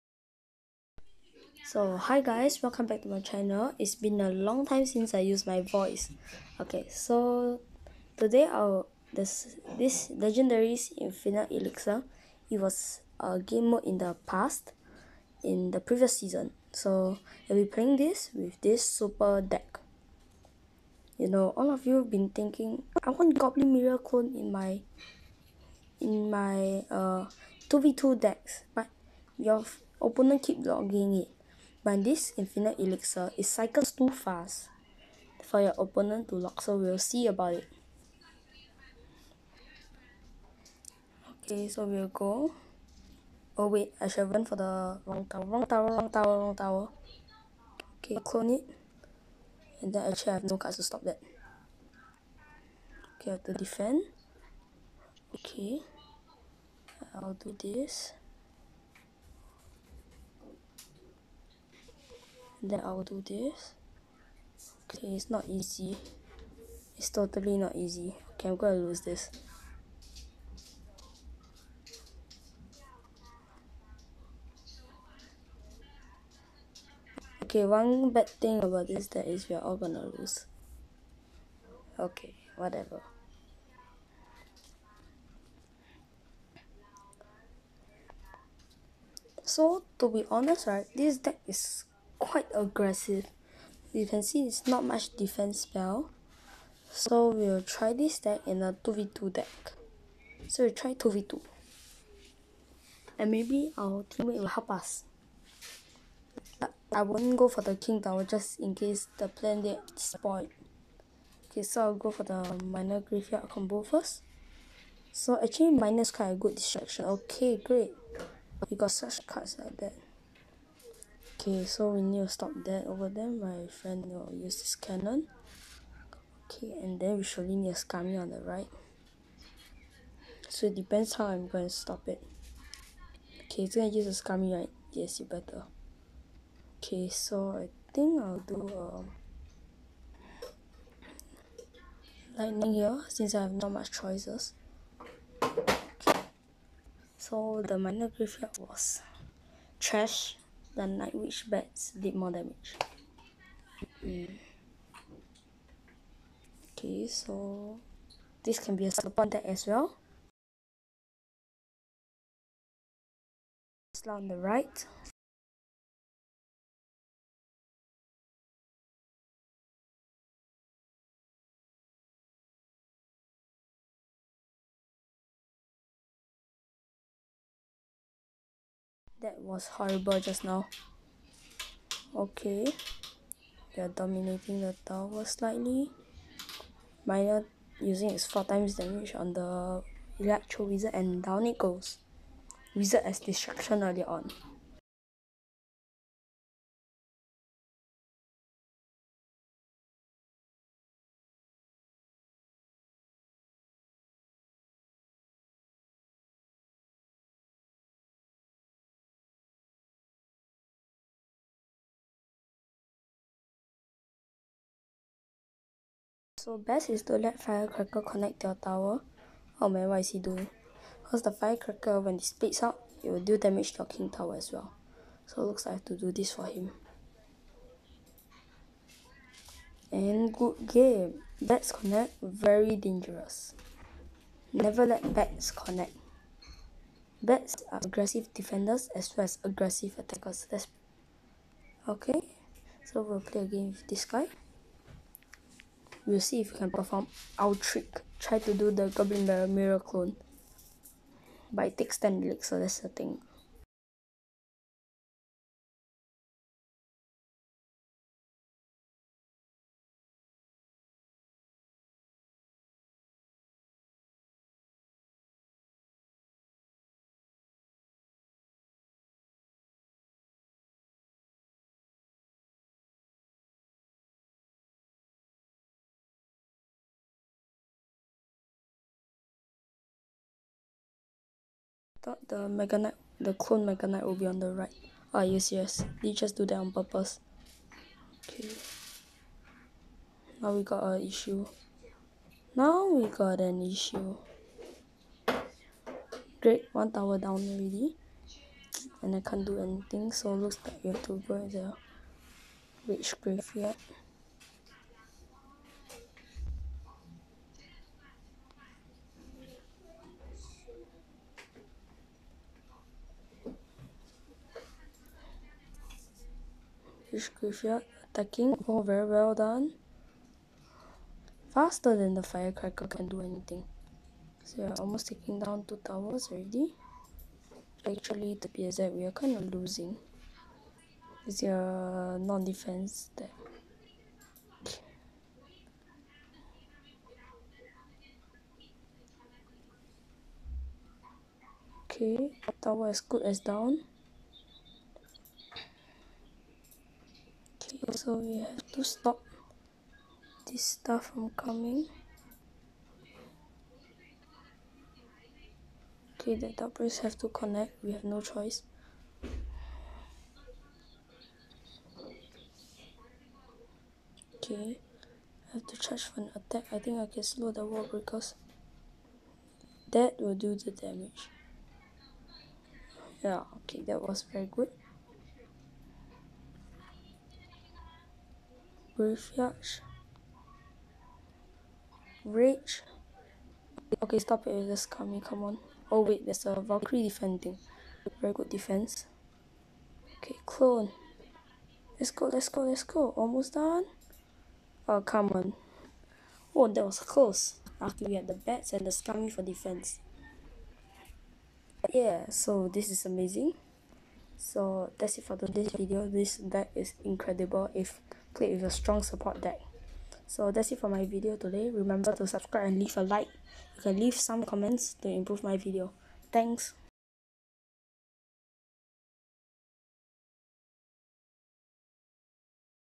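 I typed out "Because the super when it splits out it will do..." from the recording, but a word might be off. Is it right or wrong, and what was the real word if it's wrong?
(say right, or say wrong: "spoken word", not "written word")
wrong: "firecracker", not "super".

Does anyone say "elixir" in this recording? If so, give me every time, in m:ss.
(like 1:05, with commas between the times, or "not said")
0:11, 0:32.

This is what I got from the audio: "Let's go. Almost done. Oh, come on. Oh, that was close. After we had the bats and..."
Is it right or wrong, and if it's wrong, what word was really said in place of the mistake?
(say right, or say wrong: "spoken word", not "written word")
right.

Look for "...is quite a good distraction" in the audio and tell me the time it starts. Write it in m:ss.
1:56.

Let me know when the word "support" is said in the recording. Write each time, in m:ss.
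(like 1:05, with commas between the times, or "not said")
2:38, 6:49.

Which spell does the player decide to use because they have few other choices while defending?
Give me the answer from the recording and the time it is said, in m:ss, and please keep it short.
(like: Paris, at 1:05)
Lightning, at 2:22.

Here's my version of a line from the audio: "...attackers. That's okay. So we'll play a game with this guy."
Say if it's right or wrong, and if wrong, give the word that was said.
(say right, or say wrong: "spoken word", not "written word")
right.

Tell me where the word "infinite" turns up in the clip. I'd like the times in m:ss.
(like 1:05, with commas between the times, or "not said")
0:10, 0:32.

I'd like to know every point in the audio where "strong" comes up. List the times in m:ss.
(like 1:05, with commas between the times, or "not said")
6:48.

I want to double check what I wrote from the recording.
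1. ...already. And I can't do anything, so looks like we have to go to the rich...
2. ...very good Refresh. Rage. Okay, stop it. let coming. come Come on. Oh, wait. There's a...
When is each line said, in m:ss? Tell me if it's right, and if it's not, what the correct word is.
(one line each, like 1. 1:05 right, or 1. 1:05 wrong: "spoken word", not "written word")
1. 4:57 right
2. 6:14 right.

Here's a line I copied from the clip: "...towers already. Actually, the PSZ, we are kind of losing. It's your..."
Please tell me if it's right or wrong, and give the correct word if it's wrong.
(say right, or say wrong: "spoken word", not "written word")
right.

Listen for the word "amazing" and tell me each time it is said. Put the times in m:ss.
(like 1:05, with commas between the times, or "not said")
6:43.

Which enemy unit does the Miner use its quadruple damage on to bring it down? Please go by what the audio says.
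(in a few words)
Electro Wizard.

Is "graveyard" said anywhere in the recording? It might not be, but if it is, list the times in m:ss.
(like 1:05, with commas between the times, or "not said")
1:52, 2:28, 5:03.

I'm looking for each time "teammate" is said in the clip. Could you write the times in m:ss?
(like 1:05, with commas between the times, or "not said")
1:44.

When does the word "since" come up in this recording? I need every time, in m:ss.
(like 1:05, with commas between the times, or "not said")
0:04, 2:23.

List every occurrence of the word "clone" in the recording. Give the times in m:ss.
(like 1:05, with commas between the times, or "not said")
0:23, 0:48, 4:09, 4:43, 6:30.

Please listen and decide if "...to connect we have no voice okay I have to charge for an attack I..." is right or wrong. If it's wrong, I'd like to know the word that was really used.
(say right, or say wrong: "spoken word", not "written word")
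wrong: "choice", not "voice".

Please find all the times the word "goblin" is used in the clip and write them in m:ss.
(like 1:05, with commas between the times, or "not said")
0:23, 4:08.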